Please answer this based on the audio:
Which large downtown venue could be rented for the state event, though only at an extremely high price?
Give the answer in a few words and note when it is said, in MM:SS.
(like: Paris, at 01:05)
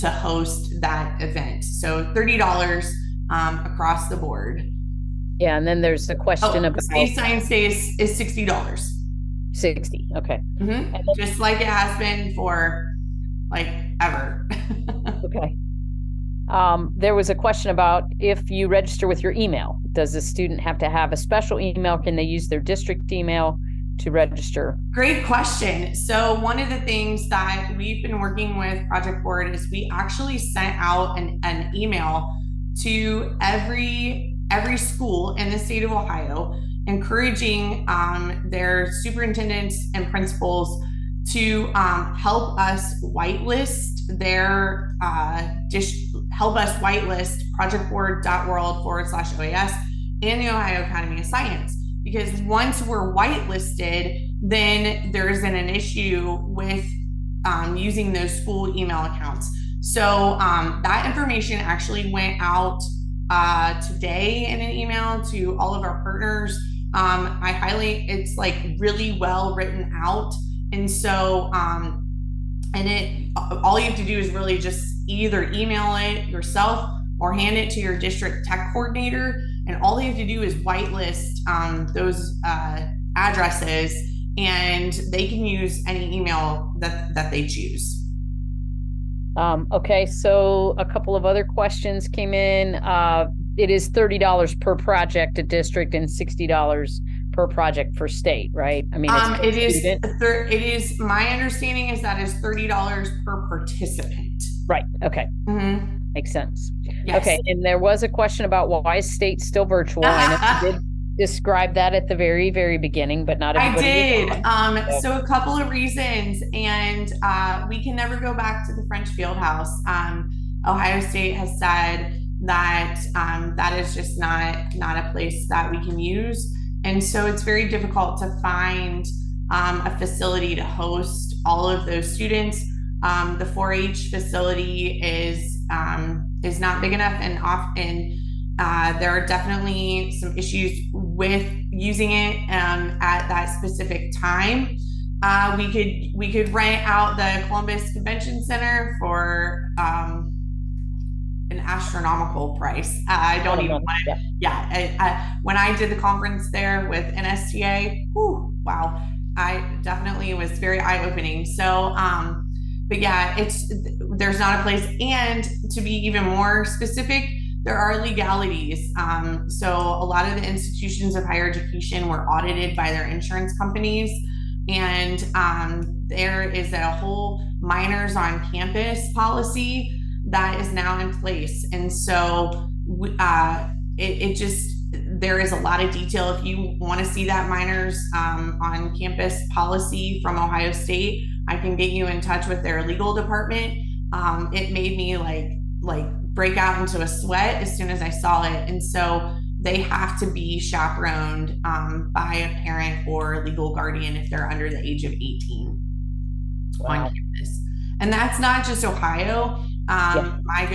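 Columbus Convention Center, at 02:27.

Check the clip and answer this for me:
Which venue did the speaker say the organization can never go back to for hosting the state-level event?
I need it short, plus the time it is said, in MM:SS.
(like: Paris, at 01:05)
French Field House, at 01:58.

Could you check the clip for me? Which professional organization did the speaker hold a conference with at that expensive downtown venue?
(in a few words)
NSTA.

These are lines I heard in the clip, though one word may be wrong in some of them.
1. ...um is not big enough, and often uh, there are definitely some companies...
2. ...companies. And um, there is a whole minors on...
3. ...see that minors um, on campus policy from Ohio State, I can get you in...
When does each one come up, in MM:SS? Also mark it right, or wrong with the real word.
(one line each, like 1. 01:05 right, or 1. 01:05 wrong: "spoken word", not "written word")
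1. 02:15 wrong: "issues", not "companies"
2. 02:53 right
3. 03:07 right.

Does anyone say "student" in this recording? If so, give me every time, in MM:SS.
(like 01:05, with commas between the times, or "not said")
00:20, 01:39, 02:12.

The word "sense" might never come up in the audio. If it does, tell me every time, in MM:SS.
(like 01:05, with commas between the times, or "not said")
01:46.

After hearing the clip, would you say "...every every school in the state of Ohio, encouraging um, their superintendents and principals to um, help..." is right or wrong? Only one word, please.
right.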